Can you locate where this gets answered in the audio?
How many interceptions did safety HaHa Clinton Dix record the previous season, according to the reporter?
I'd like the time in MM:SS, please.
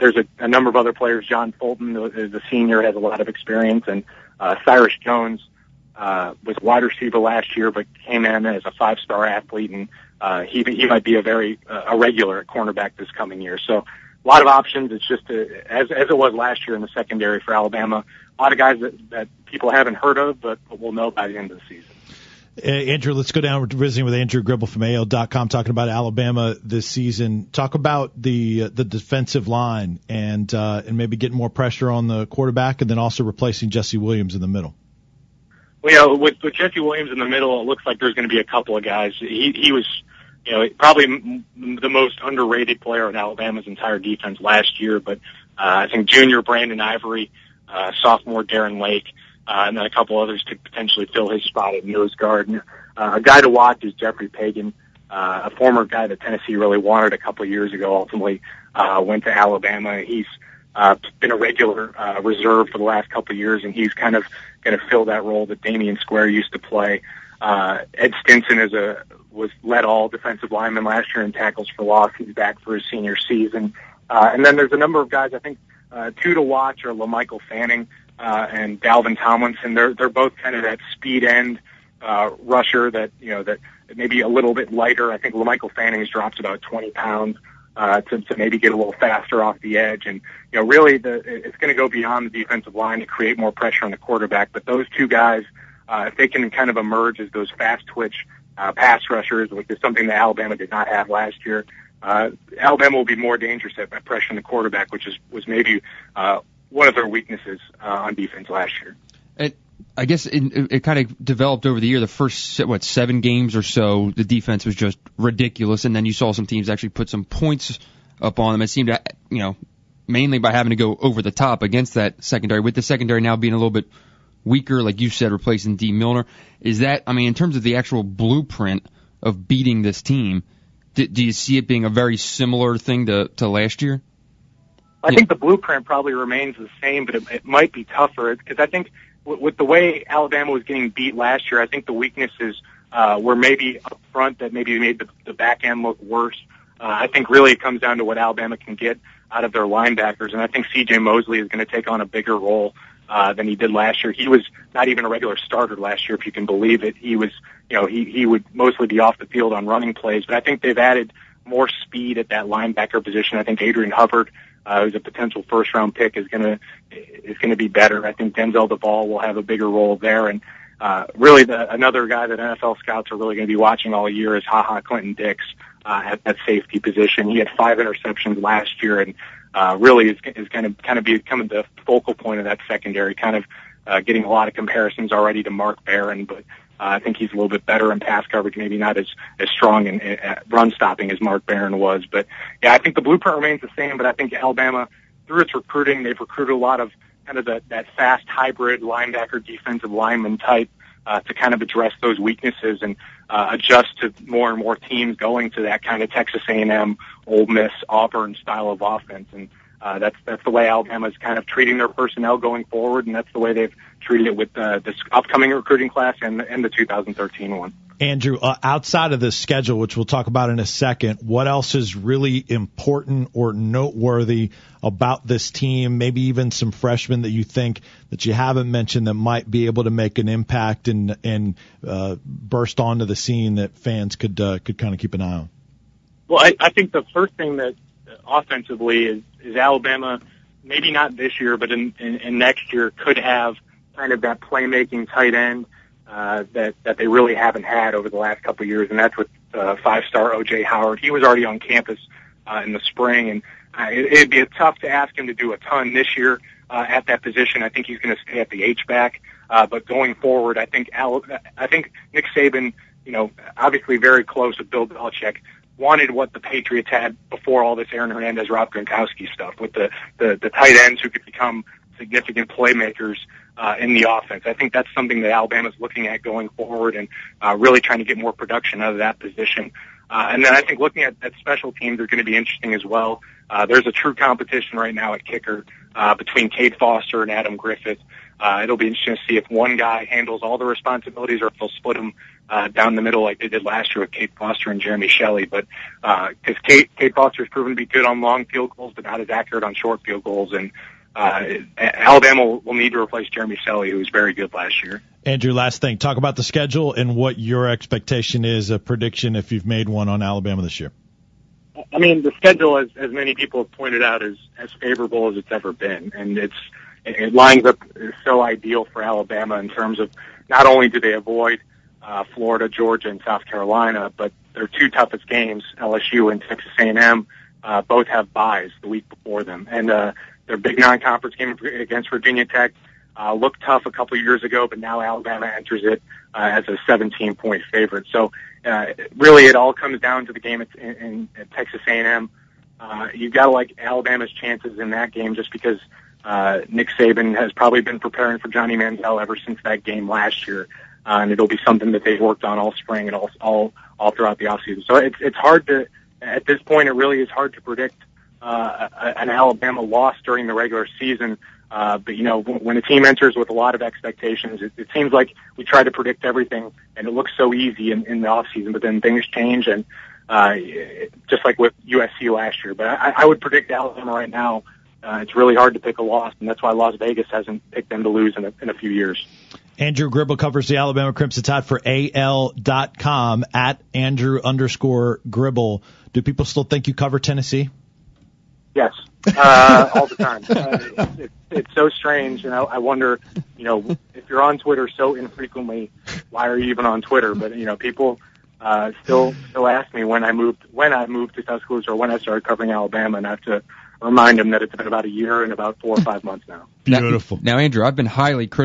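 02:57.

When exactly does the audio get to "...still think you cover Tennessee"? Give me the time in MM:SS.
06:26.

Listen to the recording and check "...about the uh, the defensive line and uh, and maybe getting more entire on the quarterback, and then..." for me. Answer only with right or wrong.
wrong.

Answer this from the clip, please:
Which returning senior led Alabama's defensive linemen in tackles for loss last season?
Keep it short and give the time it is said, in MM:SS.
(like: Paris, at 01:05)
Ed Stinson, at 01:07.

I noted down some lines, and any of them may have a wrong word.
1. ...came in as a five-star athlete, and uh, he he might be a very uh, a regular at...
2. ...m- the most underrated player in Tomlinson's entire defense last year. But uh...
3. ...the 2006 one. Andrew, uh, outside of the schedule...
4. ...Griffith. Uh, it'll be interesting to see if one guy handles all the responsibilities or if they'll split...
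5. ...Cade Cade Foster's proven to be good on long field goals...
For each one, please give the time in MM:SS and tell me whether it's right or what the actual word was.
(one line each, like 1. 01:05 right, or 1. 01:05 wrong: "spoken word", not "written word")
1. 00:08 right
2. 00:41 wrong: "Alabama", not "Tomlinson"
3. 03:36 wrong: "2013", not "2006"
4. 04:47 right
5. 04:56 right.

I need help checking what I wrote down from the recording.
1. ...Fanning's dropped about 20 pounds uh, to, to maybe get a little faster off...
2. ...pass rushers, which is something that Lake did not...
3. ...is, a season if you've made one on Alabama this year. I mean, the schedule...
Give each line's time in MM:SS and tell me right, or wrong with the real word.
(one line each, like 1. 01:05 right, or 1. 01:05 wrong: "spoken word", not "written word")
1. 01:25 right
2. 01:38 wrong: "Alabama", not "Lake"
3. 05:08 wrong: "prediction", not "season".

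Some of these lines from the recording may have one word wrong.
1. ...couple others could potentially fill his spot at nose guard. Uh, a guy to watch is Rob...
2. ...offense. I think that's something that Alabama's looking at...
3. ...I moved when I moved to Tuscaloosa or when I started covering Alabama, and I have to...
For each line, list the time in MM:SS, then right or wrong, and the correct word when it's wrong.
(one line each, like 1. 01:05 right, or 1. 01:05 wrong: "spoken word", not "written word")
1. 00:49 wrong: "Jeffrey", not "Rob"
2. 04:34 right
3. 06:40 right.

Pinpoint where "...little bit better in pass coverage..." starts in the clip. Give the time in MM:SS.
03:07.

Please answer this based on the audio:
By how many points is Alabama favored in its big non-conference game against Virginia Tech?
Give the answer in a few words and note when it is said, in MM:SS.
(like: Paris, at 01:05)
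17, at 05:36.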